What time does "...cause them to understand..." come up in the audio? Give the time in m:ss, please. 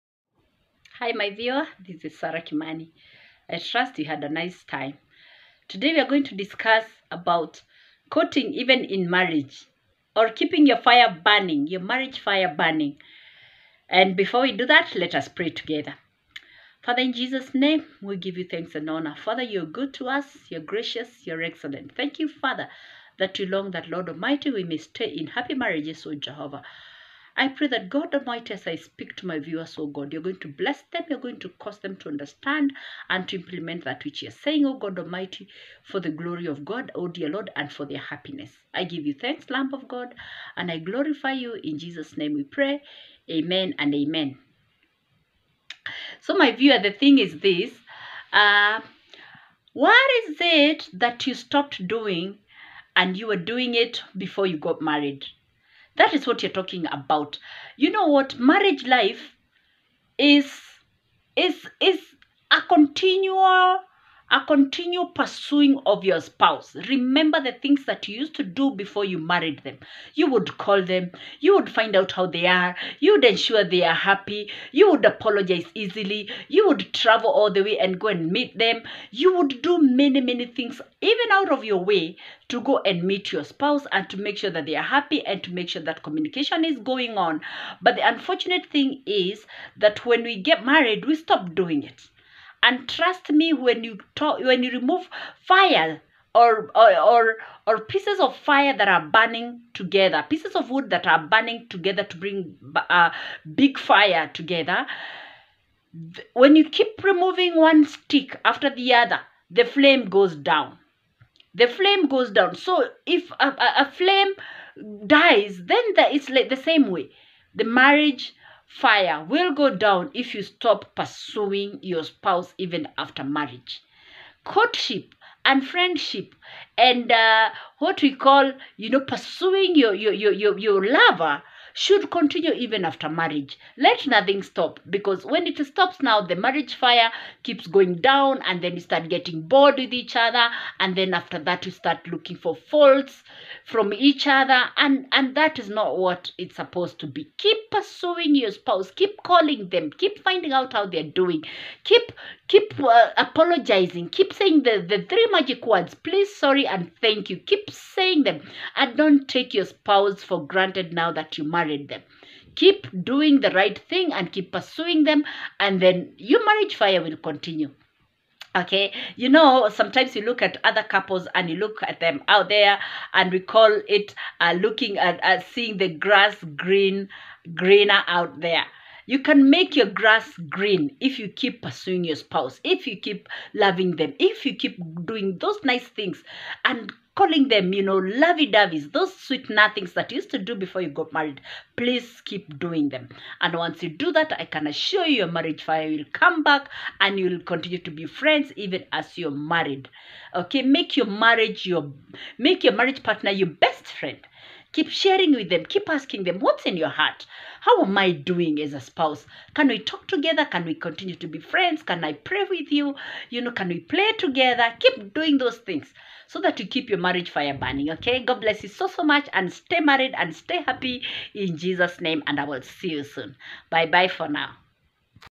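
0:31.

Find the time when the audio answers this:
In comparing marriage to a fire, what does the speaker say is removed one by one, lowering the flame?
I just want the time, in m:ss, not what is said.
1:40.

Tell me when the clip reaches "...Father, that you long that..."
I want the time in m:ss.
0:22.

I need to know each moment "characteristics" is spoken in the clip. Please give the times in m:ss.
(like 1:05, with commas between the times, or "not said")
not said.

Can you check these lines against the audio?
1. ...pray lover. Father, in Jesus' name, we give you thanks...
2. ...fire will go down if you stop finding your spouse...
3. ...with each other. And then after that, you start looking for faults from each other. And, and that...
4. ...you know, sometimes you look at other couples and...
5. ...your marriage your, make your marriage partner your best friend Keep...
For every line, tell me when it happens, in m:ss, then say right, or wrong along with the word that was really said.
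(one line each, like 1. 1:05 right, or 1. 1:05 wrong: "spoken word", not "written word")
1. 0:15 wrong: "together", not "lover"
2. 1:58 wrong: "pursuing", not "finding"
3. 2:19 right
4. 2:49 right
5. 3:20 right.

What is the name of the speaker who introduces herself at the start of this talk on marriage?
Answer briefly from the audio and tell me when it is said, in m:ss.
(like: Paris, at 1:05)
Sarah Kimani, at 0:02.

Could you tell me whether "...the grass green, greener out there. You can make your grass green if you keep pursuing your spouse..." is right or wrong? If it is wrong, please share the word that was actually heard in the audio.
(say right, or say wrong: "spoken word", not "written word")
right.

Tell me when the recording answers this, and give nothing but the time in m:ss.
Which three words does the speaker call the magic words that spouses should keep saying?
2:35.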